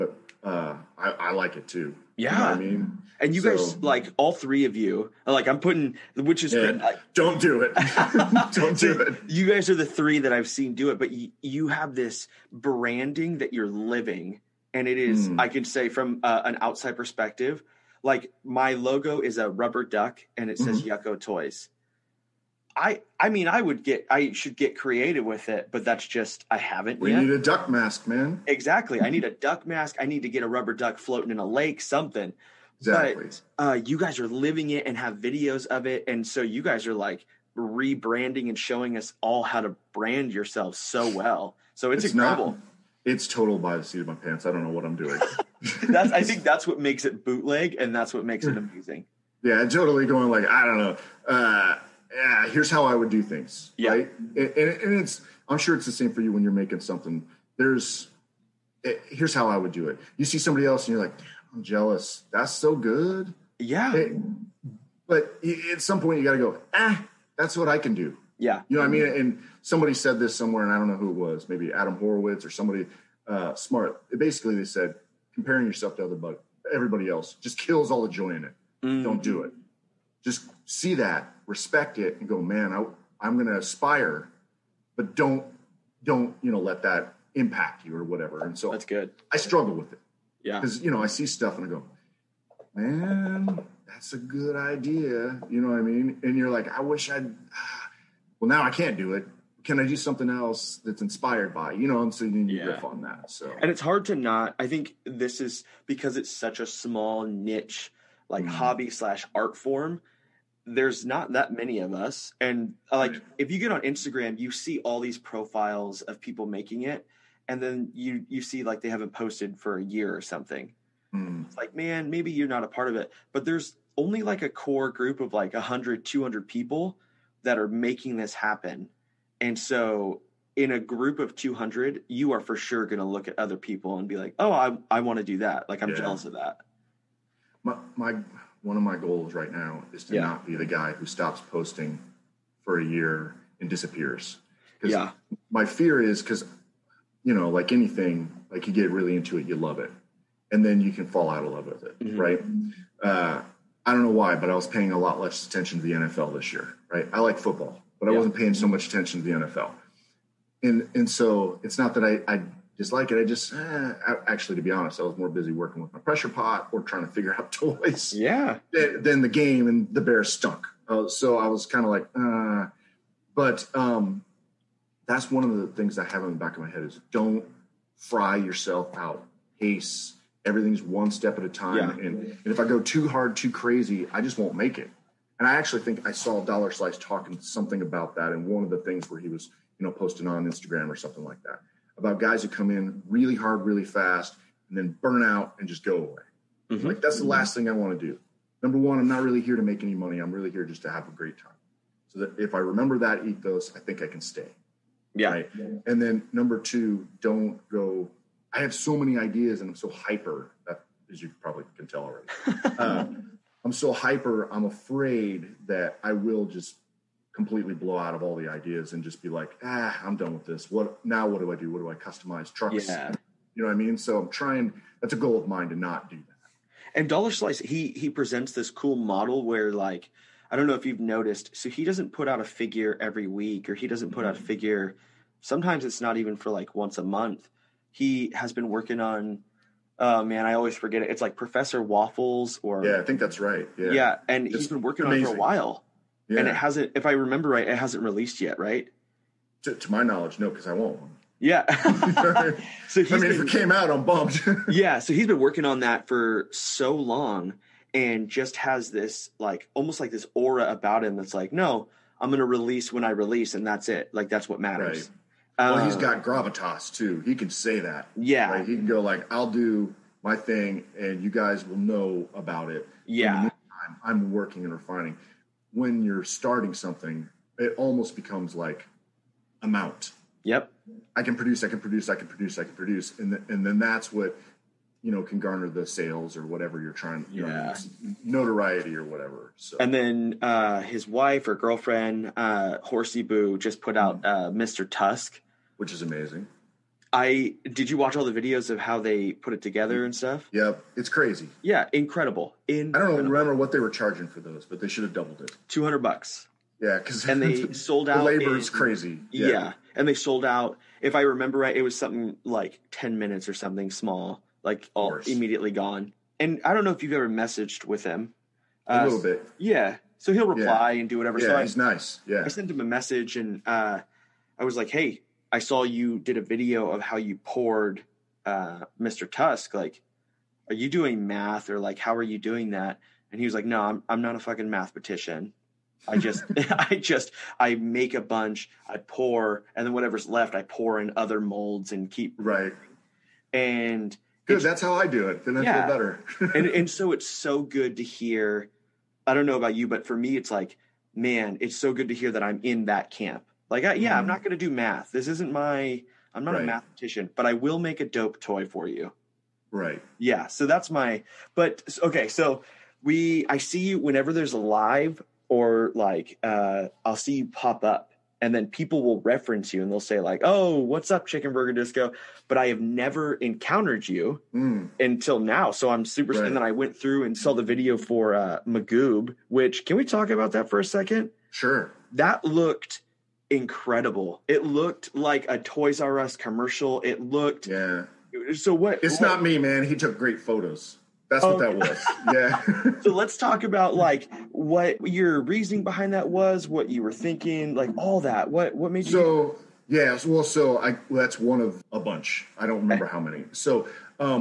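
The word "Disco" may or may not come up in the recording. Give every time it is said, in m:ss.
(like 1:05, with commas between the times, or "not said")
6:11.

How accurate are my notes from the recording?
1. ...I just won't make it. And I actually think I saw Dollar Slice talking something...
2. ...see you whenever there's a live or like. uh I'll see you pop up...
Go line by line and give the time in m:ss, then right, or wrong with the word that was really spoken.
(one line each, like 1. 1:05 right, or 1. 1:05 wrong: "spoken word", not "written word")
1. 3:04 right
2. 6:03 right.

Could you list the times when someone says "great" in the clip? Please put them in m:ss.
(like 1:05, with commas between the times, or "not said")
3:21, 6:30.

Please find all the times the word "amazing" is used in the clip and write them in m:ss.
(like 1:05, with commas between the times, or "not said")
0:48, 4:05, 4:56.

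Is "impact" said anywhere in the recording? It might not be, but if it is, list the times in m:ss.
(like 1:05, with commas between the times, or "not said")
1:27.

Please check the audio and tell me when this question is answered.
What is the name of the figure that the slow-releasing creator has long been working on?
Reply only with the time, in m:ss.
4:01.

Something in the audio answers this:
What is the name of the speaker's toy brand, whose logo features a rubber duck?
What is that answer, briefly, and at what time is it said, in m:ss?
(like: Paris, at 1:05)
Yucko Toys, at 0:21.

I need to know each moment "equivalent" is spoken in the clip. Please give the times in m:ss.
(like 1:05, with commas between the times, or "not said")
not said.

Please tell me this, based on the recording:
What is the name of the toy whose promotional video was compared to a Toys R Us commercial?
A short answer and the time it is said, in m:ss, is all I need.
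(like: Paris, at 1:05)
Magoob, at 6:18.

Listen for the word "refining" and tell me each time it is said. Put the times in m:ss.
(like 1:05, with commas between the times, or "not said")
4:34.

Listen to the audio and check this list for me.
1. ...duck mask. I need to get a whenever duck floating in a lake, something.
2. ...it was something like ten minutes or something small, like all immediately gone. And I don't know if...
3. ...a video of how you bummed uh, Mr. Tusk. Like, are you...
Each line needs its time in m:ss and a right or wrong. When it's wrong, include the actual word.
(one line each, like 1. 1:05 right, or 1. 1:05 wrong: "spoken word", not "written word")
1. 0:29 wrong: "rubber", not "whenever"
2. 5:11 right
3. 5:26 wrong: "poured", not "bummed".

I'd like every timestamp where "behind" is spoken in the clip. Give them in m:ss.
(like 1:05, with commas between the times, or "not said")
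6:35.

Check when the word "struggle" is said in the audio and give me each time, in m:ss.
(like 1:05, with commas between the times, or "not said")
1:29.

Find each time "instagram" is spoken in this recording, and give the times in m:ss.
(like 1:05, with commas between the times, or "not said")
1:53, 3:10.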